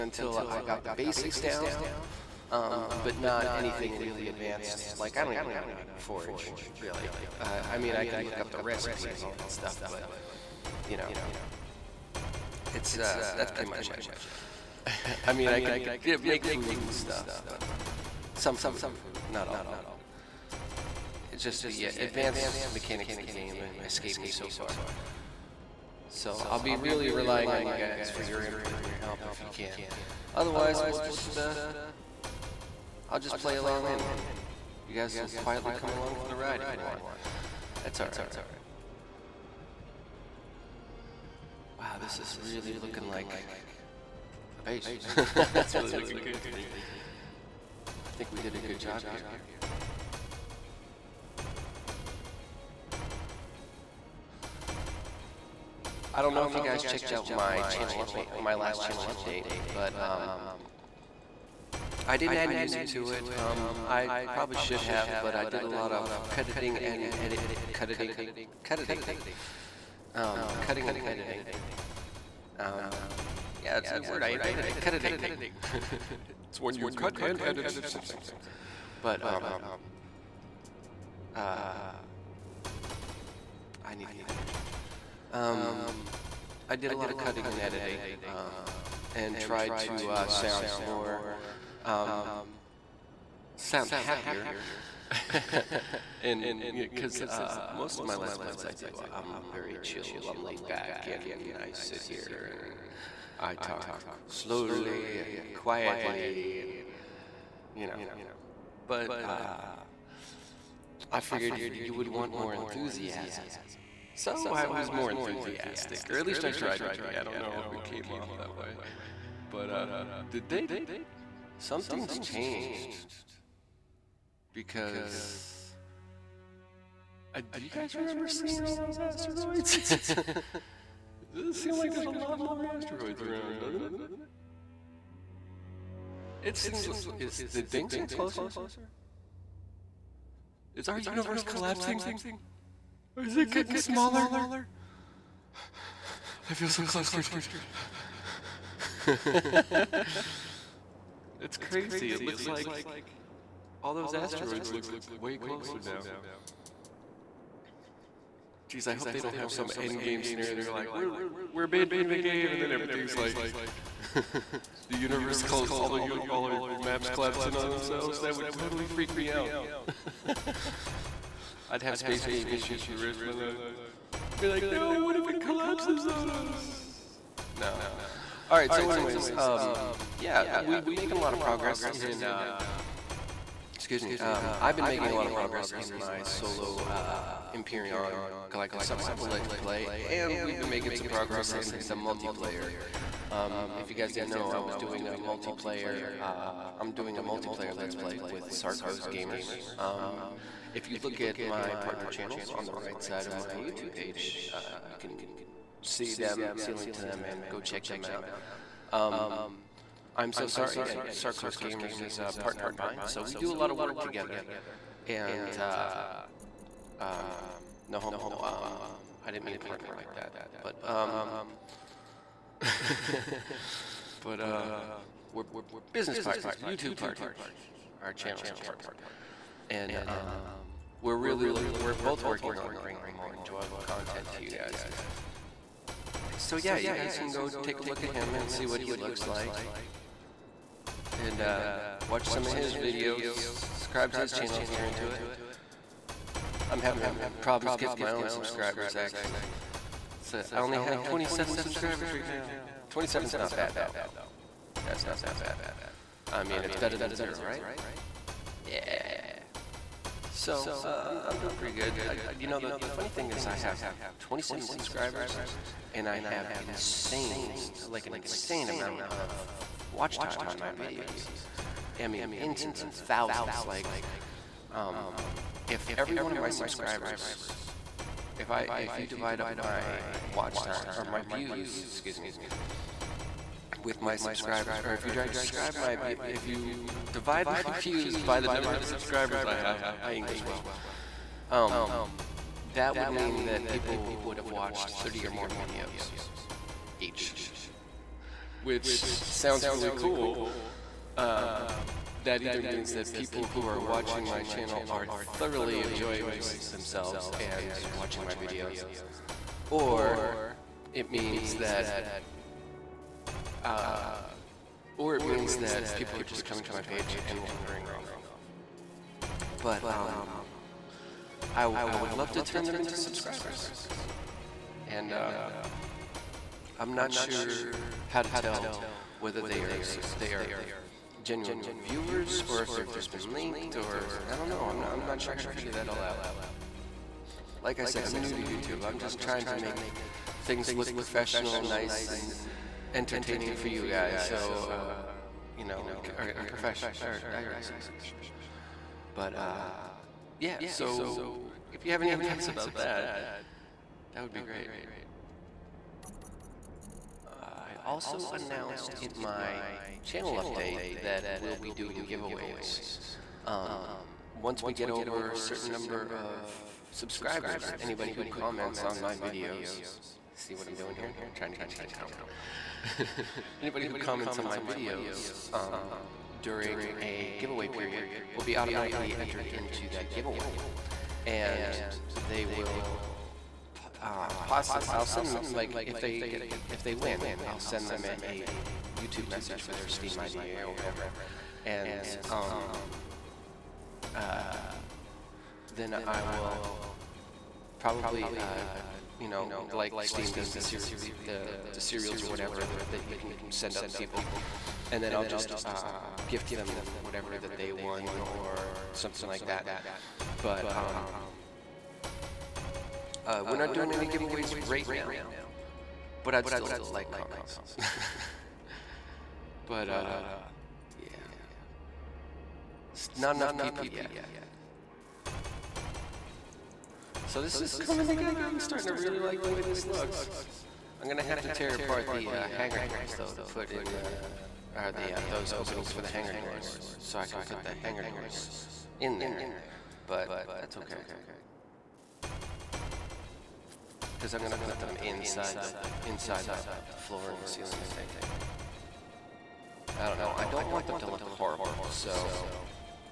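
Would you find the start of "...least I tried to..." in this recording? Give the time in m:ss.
1:56.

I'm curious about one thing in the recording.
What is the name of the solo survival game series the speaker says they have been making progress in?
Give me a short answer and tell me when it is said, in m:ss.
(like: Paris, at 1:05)
Imperion Collective Survival, at 3:07.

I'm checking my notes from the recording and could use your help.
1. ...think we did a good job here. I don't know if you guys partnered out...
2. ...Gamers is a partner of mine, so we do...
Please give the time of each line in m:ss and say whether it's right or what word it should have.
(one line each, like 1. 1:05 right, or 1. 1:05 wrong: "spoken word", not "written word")
1. 0:48 wrong: "checked", not "partnered"
2. 3:31 right.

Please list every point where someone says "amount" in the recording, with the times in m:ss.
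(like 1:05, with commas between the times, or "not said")
4:28.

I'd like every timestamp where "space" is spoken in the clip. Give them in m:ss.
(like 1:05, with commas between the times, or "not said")
2:51.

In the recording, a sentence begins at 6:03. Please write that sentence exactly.
Um, once we get over a certain number of subscribers, anybody who comments on my videos, see what I'm doing here?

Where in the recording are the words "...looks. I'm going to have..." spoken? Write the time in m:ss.
7:09.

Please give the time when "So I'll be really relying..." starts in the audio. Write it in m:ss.
0:26.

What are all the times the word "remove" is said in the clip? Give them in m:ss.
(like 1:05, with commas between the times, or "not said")
not said.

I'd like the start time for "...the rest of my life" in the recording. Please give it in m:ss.
2:52.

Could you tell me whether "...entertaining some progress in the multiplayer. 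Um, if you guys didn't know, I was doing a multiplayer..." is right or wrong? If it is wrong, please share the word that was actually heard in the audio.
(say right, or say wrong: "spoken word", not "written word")
wrong: "making", not "entertaining".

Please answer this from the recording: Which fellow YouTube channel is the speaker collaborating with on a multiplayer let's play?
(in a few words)
Sarko's Gamers.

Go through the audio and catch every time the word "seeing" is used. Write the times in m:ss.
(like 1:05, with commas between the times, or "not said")
2:08.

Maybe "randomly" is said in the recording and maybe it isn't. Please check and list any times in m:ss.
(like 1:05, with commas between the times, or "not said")
not said.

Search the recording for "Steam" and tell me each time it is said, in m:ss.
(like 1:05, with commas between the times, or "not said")
6:29, 6:40.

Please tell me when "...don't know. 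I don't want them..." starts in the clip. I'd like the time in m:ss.
7:30.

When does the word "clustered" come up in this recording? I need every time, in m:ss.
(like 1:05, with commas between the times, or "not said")
2:26.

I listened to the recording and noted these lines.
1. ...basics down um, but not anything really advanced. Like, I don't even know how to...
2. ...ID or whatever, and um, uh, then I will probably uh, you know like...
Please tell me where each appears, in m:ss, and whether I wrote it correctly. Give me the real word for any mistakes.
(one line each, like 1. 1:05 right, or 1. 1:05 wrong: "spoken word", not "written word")
1. 0:00 right
2. 6:30 right.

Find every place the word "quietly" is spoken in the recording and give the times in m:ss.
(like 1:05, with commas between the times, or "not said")
0:35, 1:45.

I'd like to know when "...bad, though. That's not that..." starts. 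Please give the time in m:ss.
4:13.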